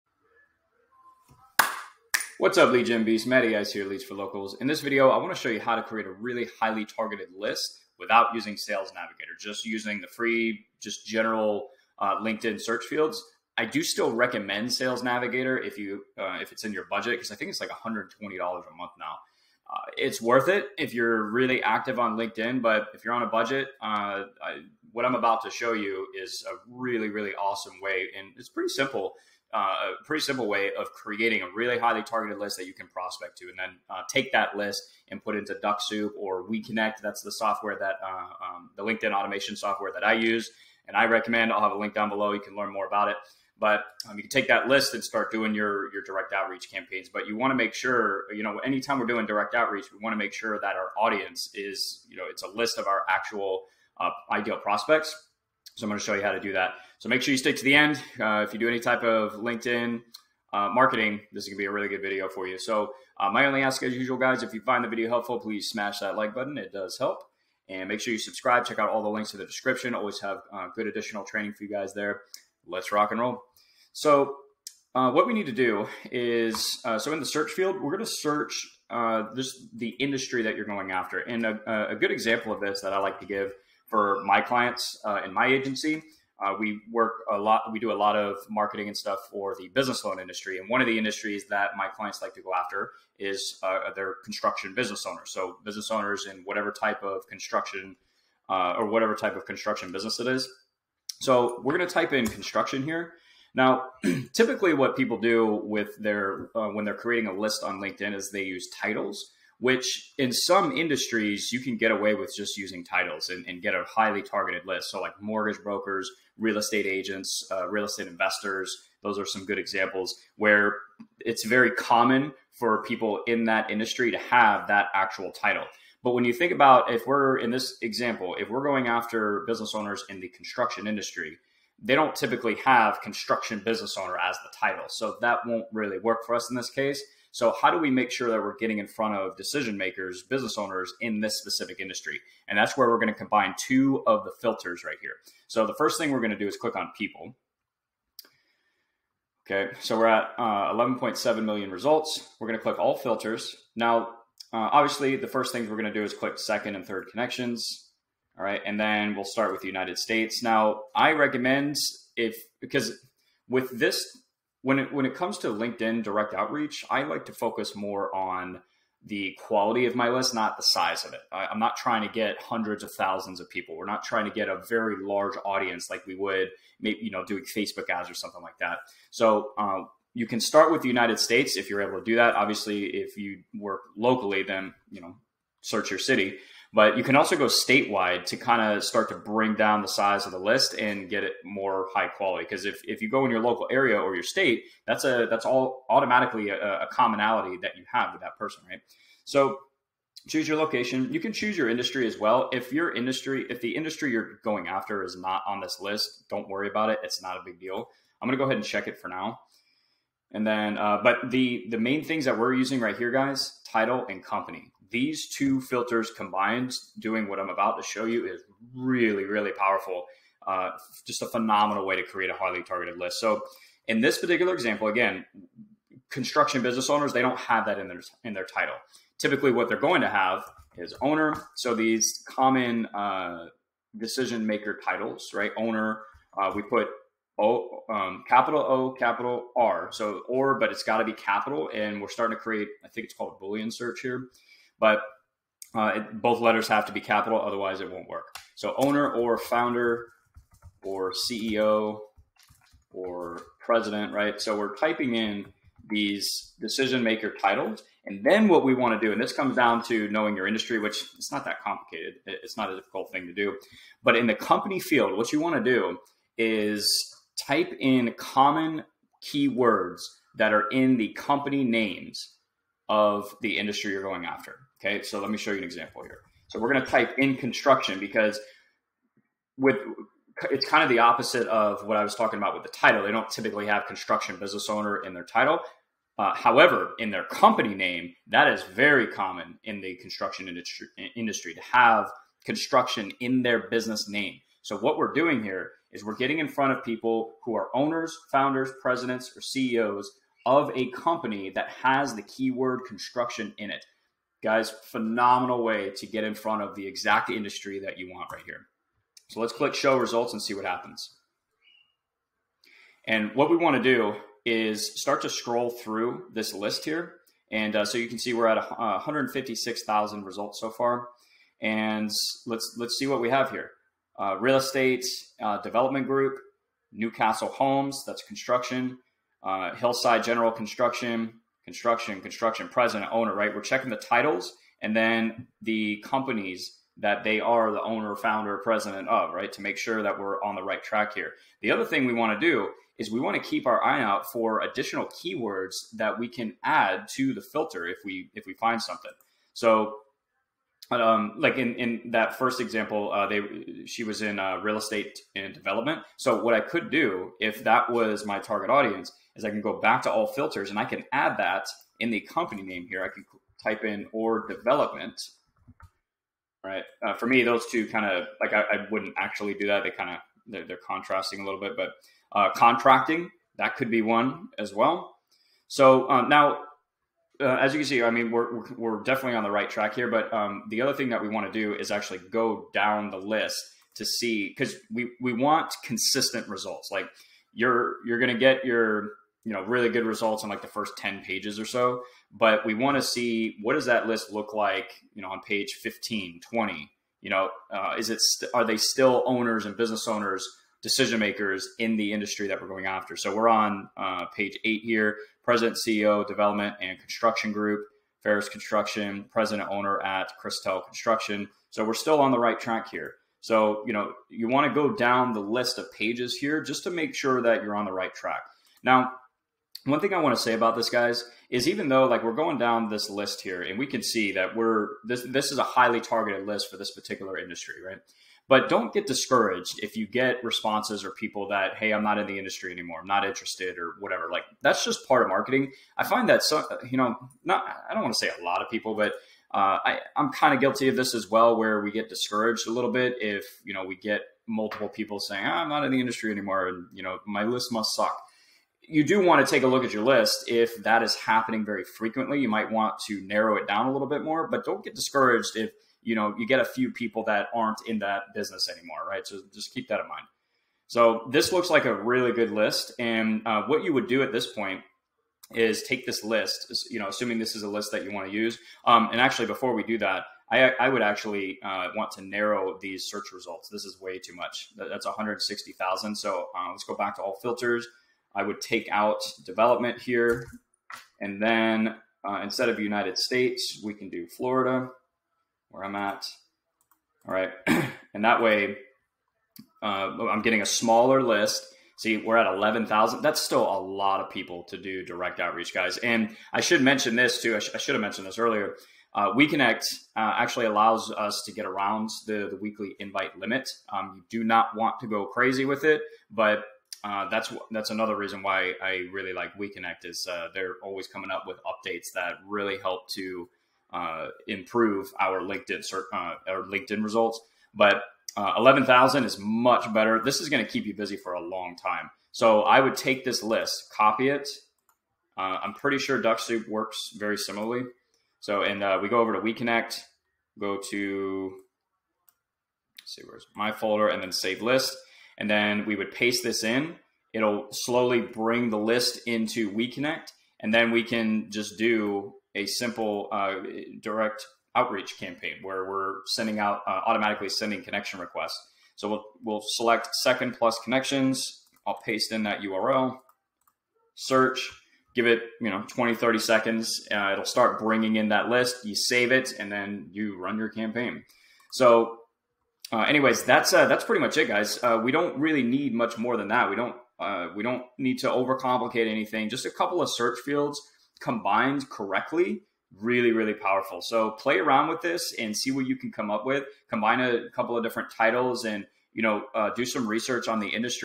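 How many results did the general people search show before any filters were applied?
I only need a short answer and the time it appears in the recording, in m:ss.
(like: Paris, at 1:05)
11.7 million, at 2:30.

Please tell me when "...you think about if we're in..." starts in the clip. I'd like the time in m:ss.
2:06.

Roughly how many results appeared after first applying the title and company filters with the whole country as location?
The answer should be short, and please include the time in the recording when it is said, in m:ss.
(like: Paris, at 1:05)
156,000, at 5:18.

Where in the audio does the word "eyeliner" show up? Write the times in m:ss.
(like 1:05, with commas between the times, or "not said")
not said.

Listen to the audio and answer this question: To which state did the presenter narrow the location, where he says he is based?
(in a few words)
Florida.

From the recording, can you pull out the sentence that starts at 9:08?
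So we'll, we'll select second plus connections.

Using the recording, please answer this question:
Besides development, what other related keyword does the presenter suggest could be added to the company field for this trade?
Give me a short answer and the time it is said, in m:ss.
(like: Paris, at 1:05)
contracting, at 6:12.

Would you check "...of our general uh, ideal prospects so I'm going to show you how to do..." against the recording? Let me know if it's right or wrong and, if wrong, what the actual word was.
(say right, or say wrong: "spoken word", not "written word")
wrong: "actual", not "general".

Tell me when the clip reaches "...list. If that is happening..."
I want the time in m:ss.
7:30.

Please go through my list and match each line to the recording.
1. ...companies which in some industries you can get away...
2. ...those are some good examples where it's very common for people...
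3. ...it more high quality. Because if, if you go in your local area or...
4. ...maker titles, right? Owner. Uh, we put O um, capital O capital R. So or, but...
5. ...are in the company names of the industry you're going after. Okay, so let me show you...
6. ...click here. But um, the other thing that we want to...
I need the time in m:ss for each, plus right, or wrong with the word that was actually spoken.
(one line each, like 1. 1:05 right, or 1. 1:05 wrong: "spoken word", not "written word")
1. 1:48 wrong: "titles", not "companies"
2. 1:59 right
3. 3:11 right
4. 3:54 right
5. 4:30 right
6. 6:19 wrong: "track", not "click".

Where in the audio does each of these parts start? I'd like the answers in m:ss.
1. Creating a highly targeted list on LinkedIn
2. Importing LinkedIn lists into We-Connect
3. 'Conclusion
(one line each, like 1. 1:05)
1. 1:15
2. 8:47
3. 9:23.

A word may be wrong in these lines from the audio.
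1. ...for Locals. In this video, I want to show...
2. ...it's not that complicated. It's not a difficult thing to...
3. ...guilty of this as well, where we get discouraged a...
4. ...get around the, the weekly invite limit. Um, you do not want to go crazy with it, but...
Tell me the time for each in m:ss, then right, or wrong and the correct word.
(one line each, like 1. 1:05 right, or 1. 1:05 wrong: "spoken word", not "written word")
1. 0:04 right
2. 4:21 right
3. 7:20 right
4. 8:21 right.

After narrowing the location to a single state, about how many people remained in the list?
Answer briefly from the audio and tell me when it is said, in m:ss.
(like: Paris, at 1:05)
11,000, at 8:12.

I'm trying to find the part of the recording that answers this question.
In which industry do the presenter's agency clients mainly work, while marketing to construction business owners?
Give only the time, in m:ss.
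1:29.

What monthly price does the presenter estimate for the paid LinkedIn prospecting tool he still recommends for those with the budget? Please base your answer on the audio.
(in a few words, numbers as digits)
$120.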